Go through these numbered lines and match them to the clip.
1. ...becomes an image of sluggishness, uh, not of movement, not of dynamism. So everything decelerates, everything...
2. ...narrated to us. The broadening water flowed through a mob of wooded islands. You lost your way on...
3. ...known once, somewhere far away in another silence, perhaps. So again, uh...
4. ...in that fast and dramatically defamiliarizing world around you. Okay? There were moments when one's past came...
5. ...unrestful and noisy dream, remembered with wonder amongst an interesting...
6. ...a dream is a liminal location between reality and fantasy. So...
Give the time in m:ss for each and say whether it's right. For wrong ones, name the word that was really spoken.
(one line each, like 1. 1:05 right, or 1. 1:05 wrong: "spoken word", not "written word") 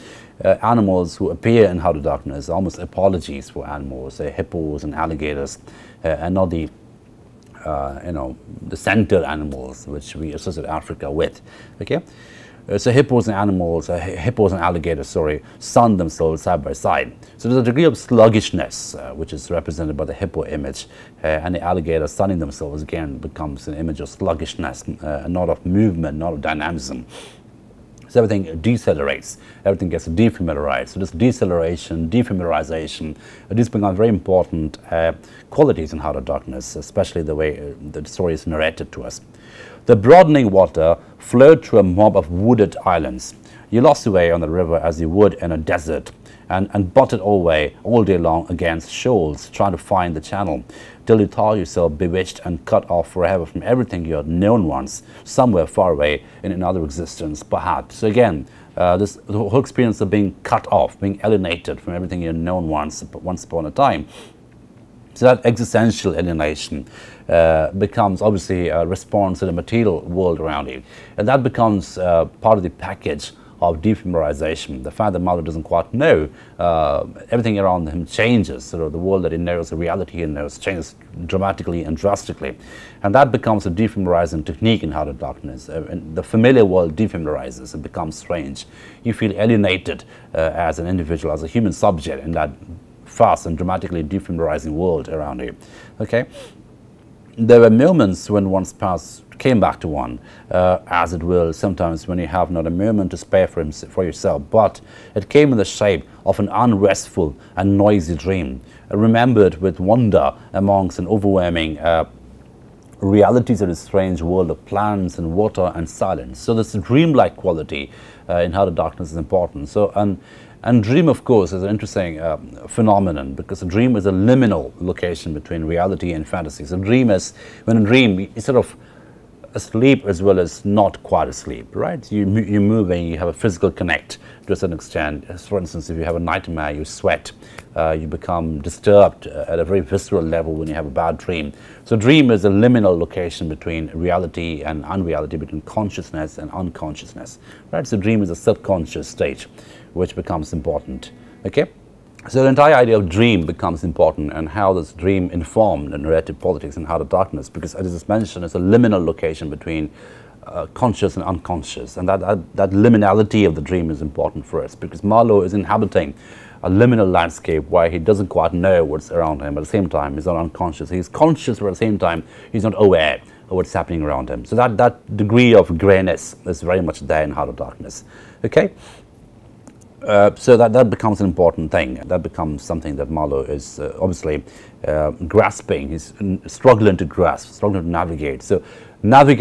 1. 0:23 right
2. 0:38 right
3. 0:54 wrong: "existence", not "silence"
4. 1:32 right
5. 1:46 wrong: "overwhelming", not "interesting"
6. 2:03 right.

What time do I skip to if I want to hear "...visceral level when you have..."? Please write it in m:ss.
2:19.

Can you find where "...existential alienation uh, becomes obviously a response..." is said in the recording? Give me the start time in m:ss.
1:05.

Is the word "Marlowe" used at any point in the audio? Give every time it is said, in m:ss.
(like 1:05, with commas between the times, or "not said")
2:45, 3:03.